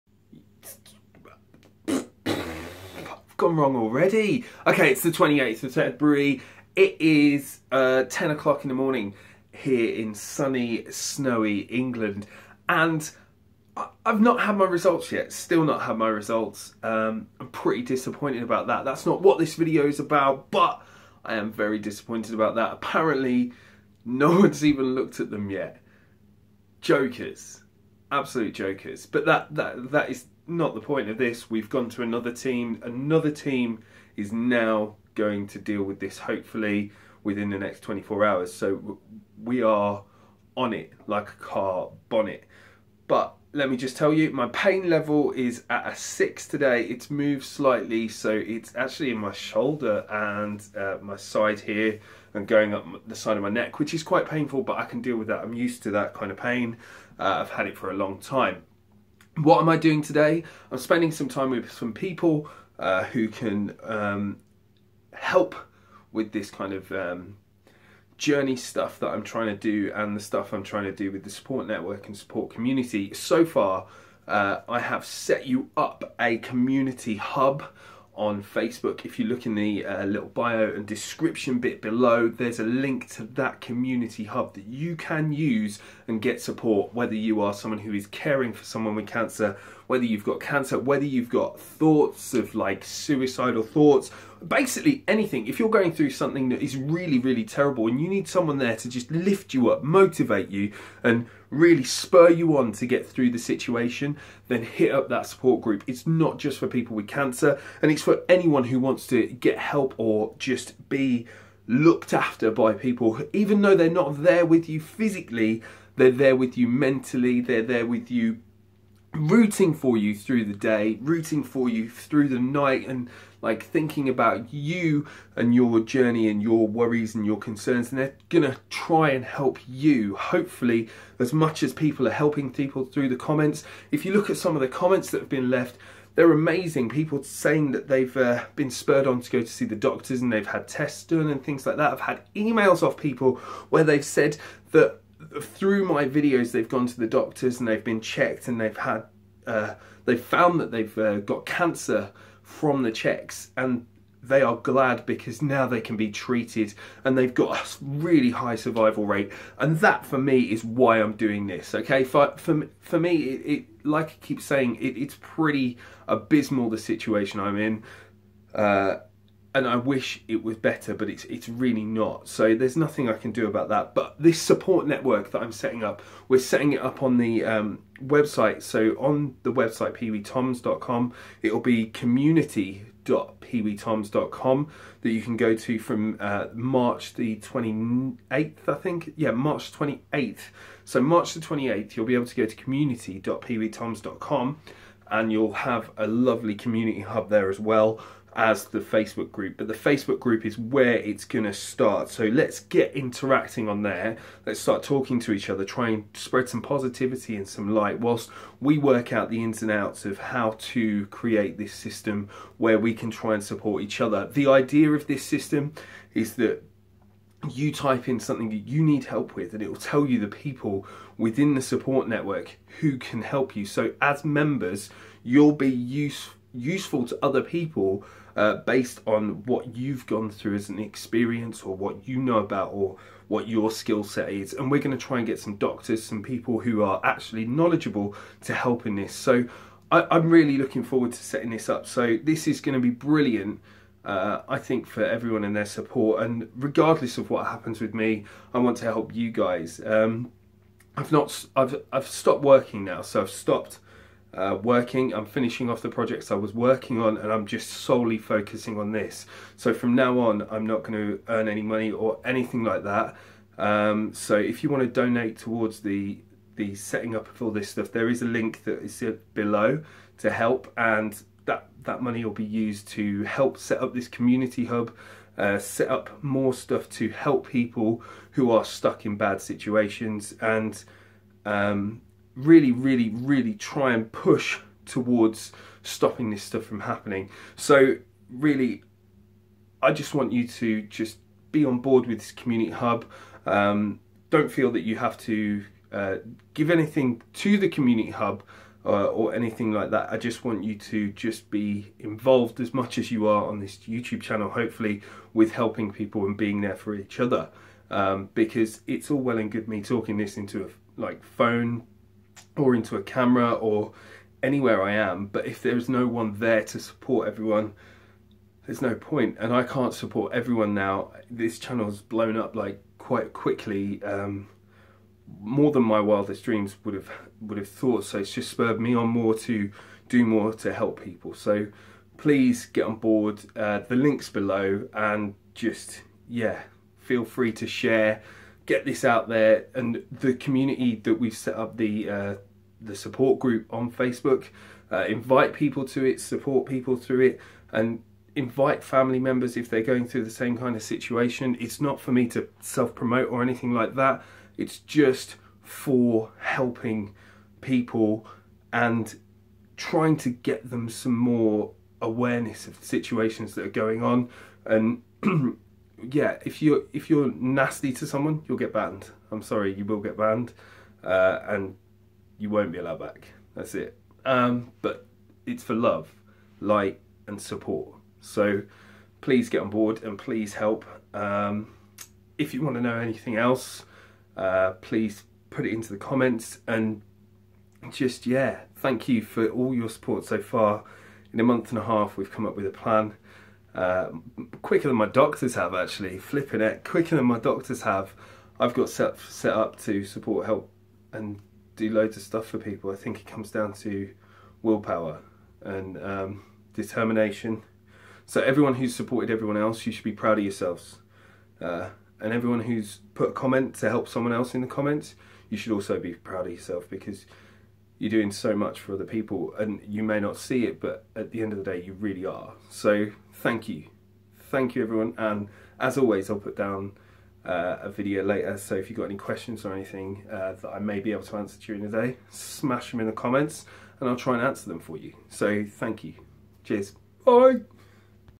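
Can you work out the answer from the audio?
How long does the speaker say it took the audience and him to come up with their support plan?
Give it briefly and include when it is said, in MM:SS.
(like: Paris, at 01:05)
a month and a half, at 06:31.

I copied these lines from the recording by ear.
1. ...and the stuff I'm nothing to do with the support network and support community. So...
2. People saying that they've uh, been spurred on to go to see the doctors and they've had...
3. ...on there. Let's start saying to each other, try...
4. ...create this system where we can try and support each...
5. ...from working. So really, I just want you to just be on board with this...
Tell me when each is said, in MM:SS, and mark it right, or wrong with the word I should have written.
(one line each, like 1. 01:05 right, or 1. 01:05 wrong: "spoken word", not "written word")
1. 01:09 wrong: "trying", not "nothing"
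2. 02:16 right
3. 03:23 wrong: "talking", not "saying"
4. 03:31 right
5. 04:46 wrong: "happening", not "working".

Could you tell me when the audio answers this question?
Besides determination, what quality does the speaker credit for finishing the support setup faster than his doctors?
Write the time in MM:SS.
06:44.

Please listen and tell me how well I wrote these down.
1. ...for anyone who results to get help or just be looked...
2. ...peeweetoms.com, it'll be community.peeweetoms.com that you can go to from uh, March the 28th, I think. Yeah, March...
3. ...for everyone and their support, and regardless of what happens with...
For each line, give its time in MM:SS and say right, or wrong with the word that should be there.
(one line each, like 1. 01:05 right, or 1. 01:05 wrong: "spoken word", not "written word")
1. 01:48 wrong: "wants", not "results"
2. 02:59 right
3. 04:04 right.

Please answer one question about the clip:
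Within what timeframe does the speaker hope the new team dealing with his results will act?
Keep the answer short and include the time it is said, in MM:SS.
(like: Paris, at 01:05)
24 hours, at 00:37.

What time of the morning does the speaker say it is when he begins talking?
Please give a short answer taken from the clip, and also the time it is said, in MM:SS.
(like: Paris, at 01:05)
10 o'clock, at 00:08.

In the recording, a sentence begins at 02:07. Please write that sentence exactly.
And they're gonna try and help you, hopefully, as much as people are helping people through the comments.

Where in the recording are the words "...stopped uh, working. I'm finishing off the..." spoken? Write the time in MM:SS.
04:13.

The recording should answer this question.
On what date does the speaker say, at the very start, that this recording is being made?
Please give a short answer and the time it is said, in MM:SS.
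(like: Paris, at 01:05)
28th of February, at 00:05.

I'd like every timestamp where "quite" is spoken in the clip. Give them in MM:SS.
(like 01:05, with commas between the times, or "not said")
00:54, 05:22.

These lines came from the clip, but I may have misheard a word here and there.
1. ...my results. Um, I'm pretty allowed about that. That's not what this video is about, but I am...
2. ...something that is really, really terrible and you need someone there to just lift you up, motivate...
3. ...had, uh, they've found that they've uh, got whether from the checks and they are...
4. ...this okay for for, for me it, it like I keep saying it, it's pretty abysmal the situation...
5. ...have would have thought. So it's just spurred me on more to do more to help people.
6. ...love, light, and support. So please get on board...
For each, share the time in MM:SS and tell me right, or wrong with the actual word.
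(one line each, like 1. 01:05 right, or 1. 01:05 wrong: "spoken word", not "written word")
1. 00:15 wrong: "disappointed", not "allowed"
2. 01:36 right
3. 02:28 wrong: "cancer", not "whether"
4. 02:41 right
5. 05:26 right
6. 06:15 right.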